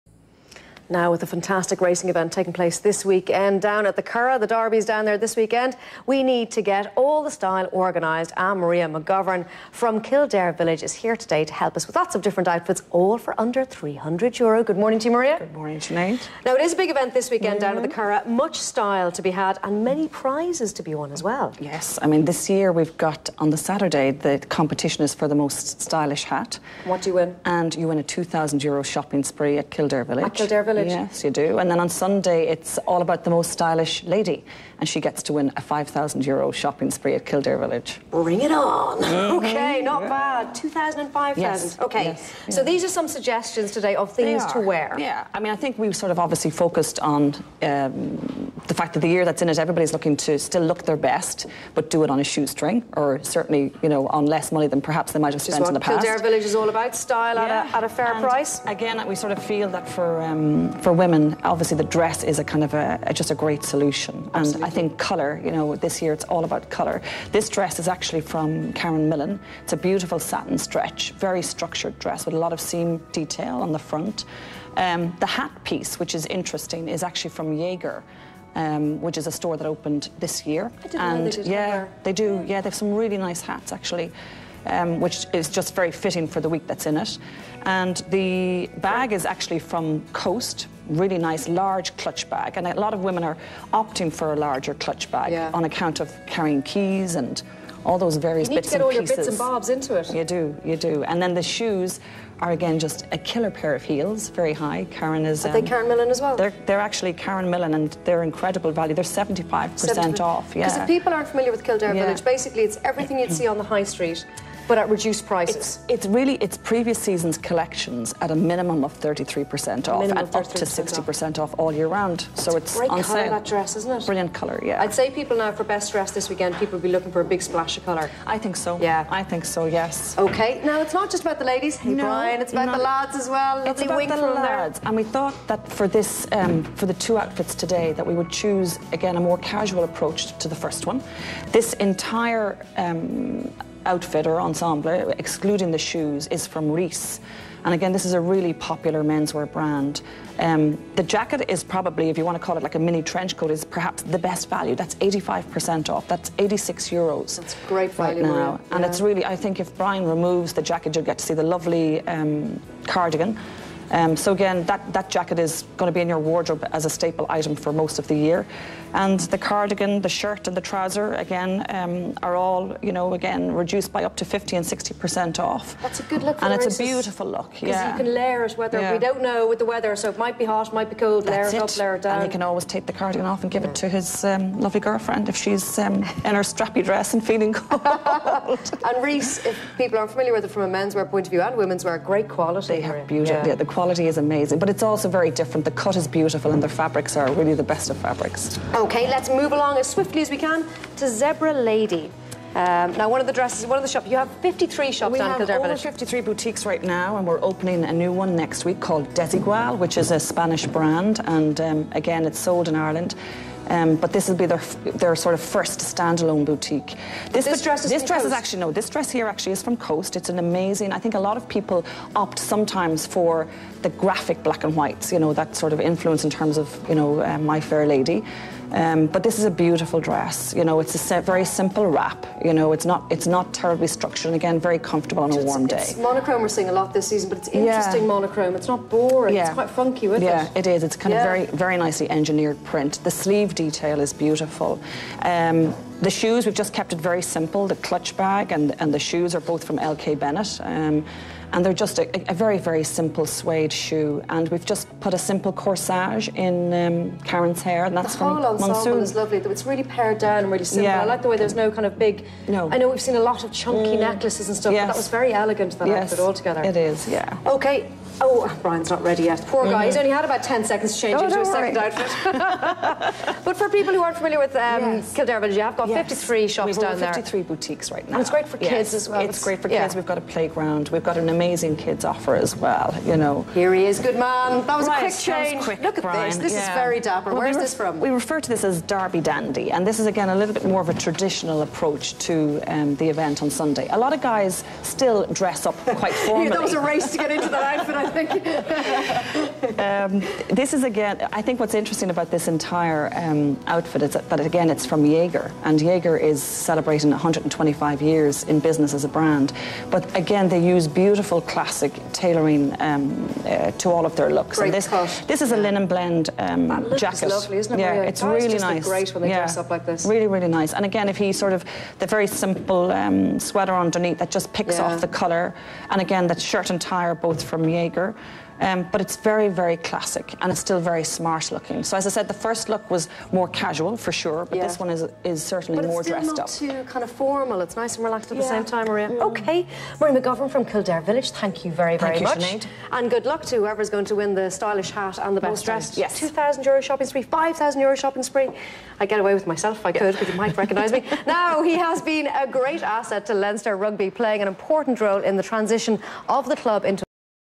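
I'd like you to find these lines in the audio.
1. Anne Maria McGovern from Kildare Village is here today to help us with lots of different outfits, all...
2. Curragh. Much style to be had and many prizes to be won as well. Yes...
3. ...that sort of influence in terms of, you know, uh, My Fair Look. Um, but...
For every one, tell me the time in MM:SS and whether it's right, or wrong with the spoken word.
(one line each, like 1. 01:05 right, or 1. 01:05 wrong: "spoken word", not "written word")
1. 00:08 right
2. 00:18 right
3. 03:45 wrong: "Lady", not "Look".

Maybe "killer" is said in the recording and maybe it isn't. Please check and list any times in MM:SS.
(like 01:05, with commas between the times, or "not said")
01:43.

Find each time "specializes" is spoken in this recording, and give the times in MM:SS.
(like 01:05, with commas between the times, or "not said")
not said.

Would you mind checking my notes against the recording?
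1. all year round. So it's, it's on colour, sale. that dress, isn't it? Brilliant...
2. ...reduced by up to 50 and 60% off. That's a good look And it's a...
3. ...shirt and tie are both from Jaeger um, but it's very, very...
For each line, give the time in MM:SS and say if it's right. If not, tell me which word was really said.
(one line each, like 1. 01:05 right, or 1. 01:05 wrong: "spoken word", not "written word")
1. 02:01 right
2. 02:53 right
3. 05:26 right.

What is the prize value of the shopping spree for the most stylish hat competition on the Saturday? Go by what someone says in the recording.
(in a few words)
2,000 euro.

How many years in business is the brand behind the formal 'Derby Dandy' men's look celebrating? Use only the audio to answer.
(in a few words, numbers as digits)
125.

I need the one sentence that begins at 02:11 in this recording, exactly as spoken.
Hey no, Brian, it's about not, the lads as well.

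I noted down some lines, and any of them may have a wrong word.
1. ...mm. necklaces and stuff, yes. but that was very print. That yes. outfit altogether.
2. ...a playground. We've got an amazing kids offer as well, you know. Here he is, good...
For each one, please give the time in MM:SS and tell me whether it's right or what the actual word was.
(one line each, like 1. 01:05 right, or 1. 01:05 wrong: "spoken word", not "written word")
1. 04:23 wrong: "elegant", not "print"
2. 04:40 right.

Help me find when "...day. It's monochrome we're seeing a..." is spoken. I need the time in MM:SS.
03:55.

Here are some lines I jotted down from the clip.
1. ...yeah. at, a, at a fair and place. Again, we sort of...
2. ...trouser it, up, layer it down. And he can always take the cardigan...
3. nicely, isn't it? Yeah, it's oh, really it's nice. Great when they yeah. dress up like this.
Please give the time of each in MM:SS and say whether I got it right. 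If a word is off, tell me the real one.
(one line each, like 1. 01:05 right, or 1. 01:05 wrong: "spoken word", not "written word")
1. 00:57 wrong: "price", not "place"
2. 03:01 wrong: "layer", not "trouser"
3. 05:17 wrong: "lovely", not "nicely".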